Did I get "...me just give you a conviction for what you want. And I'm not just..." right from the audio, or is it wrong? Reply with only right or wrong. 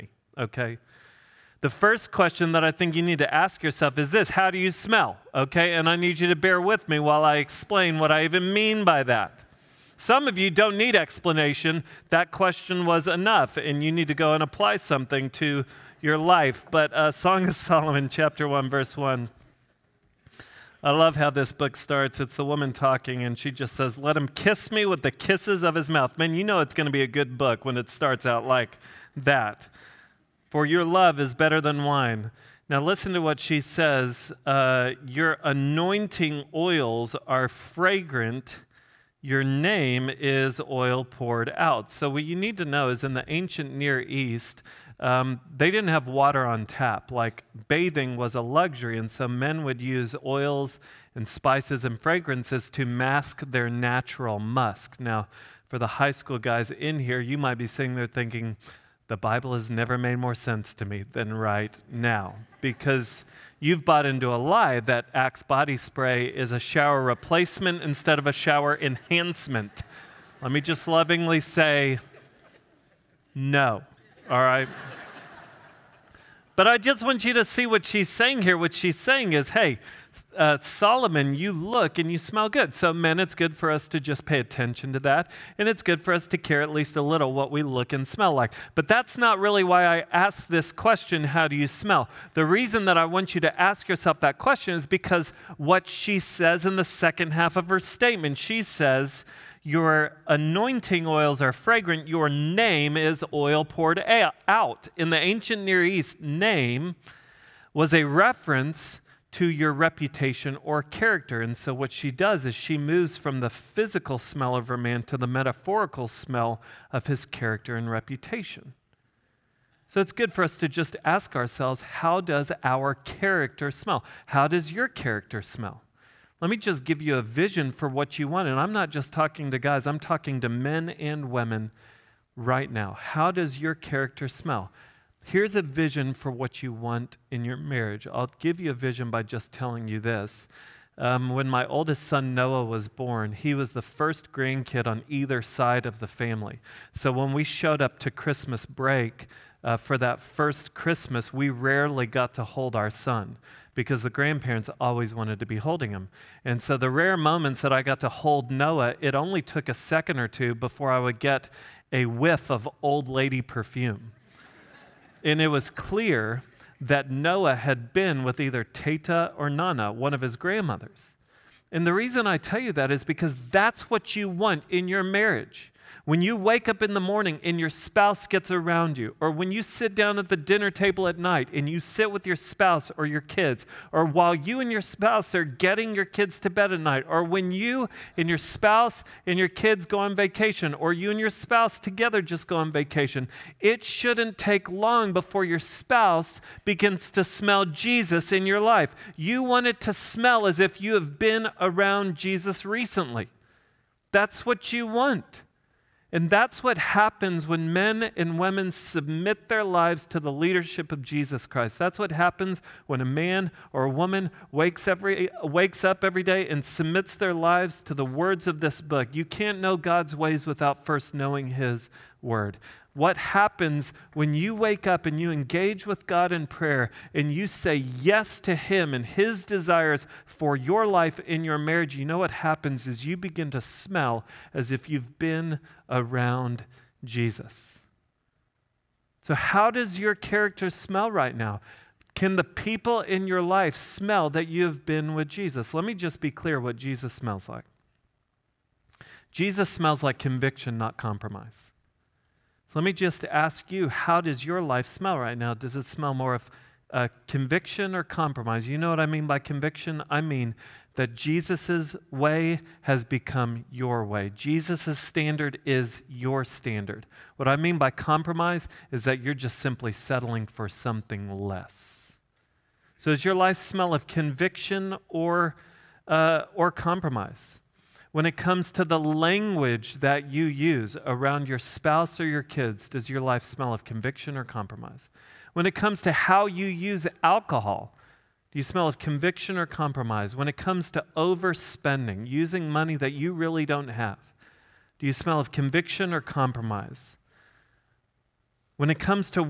wrong.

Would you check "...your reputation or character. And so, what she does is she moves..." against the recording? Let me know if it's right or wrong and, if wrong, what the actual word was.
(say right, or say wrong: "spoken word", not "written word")
right.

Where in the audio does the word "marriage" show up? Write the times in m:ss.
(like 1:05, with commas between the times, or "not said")
2:17, 2:55, 3:51.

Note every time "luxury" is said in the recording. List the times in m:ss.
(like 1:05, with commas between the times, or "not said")
0:48.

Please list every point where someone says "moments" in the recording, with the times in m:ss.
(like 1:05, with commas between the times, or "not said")
2:37.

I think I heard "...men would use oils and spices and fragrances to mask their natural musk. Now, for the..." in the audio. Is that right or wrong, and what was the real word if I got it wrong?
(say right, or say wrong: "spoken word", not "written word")
right.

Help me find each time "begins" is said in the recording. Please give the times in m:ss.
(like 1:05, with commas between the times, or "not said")
3:16, 3:53.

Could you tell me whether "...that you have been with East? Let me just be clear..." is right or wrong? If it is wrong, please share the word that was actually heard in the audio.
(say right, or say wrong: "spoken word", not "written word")
wrong: "Jesus", not "East".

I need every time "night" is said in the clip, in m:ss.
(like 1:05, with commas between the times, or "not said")
3:01, 3:06.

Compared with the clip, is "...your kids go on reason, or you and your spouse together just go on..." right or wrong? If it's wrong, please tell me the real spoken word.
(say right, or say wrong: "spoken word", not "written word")
wrong: "vacation", not "reason".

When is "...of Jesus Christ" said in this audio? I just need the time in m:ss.
3:30.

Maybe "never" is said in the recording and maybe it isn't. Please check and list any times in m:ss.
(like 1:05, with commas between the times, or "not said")
0:59.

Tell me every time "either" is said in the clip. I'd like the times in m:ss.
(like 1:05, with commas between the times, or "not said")
2:25, 2:48.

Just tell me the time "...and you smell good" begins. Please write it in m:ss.
1:21.